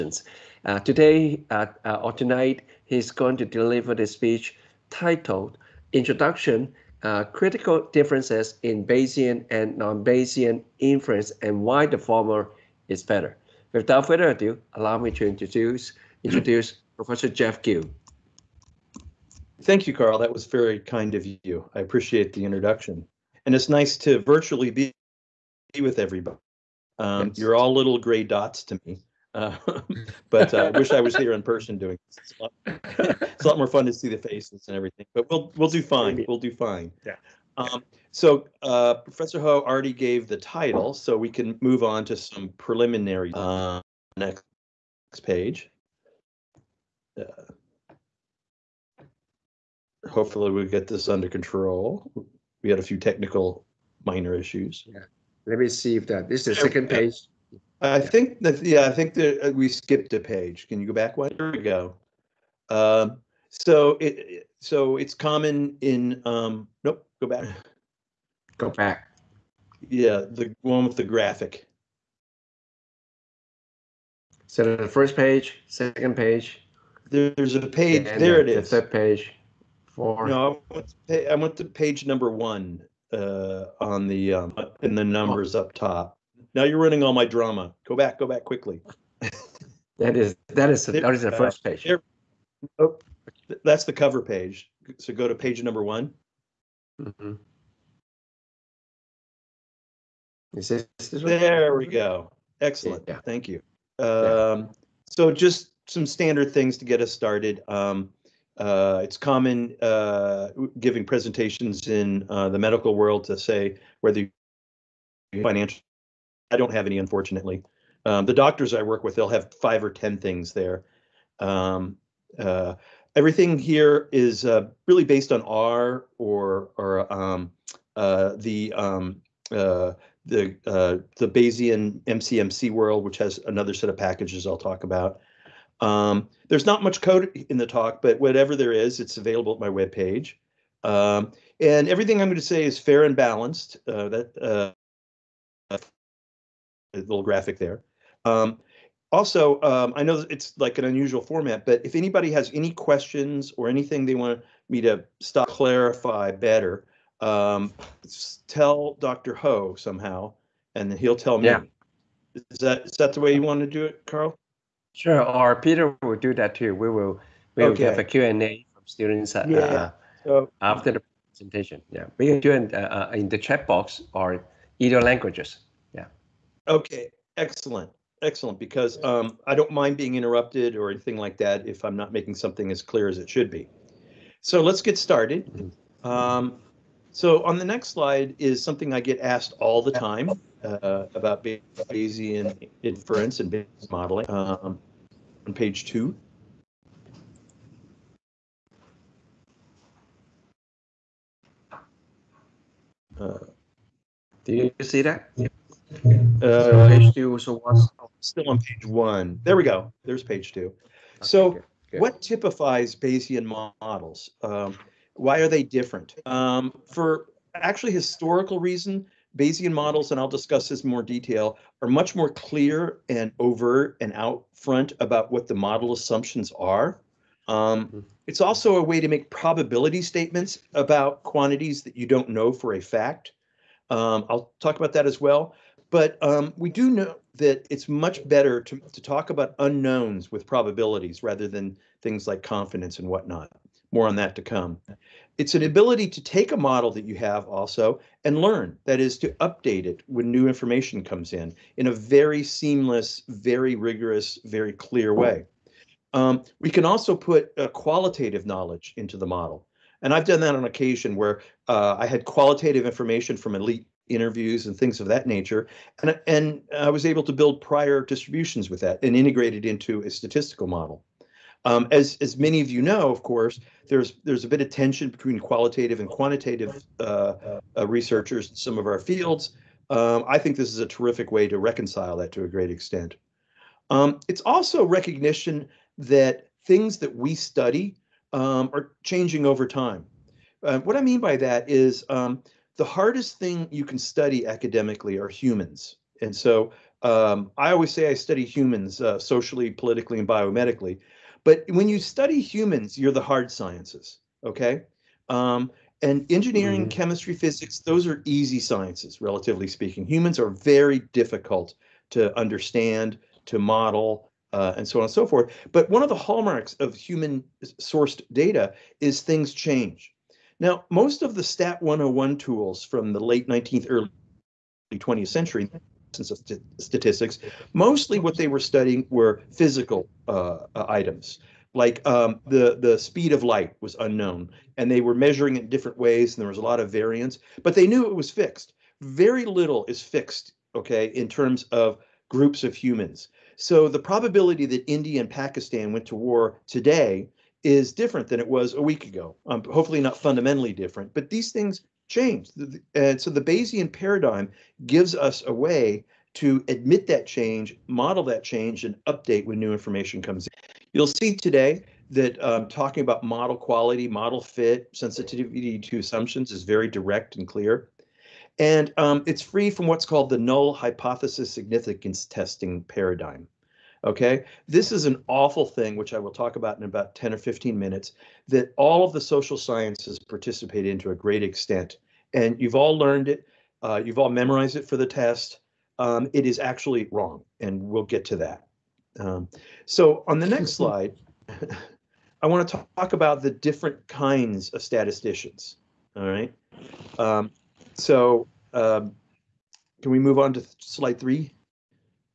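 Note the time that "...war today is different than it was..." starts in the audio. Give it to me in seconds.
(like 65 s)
346 s.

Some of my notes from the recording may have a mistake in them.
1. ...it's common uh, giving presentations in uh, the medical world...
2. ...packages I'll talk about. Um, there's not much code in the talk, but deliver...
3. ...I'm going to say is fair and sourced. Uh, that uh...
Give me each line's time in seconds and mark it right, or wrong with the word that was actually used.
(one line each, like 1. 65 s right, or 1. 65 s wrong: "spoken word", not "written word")
1. 109 s right
2. 133 s wrong: "whatever", not "deliver"
3. 142 s wrong: "balanced", not "sourced".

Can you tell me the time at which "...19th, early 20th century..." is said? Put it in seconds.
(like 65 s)
323 s.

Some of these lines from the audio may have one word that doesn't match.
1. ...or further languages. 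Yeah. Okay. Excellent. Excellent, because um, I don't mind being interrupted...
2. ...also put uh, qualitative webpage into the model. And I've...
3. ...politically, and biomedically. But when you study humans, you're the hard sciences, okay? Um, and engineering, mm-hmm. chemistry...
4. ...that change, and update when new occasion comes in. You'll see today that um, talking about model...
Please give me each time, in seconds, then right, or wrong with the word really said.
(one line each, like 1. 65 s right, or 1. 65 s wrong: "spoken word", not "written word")
1. 174 s wrong: "either", not "further"
2. 256 s wrong: "knowledge", not "webpage"
3. 299 s right
4. 358 s wrong: "information", not "occasion".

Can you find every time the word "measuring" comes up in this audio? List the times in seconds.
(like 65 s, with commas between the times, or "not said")
335 s.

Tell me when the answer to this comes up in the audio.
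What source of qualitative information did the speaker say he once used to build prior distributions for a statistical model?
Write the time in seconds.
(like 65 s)
263 s.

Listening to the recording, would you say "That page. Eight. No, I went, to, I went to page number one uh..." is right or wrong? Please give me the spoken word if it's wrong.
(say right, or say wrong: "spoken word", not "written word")
wrong: "Four", not "Eight".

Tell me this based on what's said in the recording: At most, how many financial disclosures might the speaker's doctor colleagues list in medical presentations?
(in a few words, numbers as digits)
10.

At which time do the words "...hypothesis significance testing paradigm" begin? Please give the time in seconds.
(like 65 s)
370 s.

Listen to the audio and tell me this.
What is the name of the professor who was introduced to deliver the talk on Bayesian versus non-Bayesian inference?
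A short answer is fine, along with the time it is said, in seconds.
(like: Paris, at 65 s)
Jeff Gu, at 17 s.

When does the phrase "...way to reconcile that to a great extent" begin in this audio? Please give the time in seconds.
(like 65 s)
281 s.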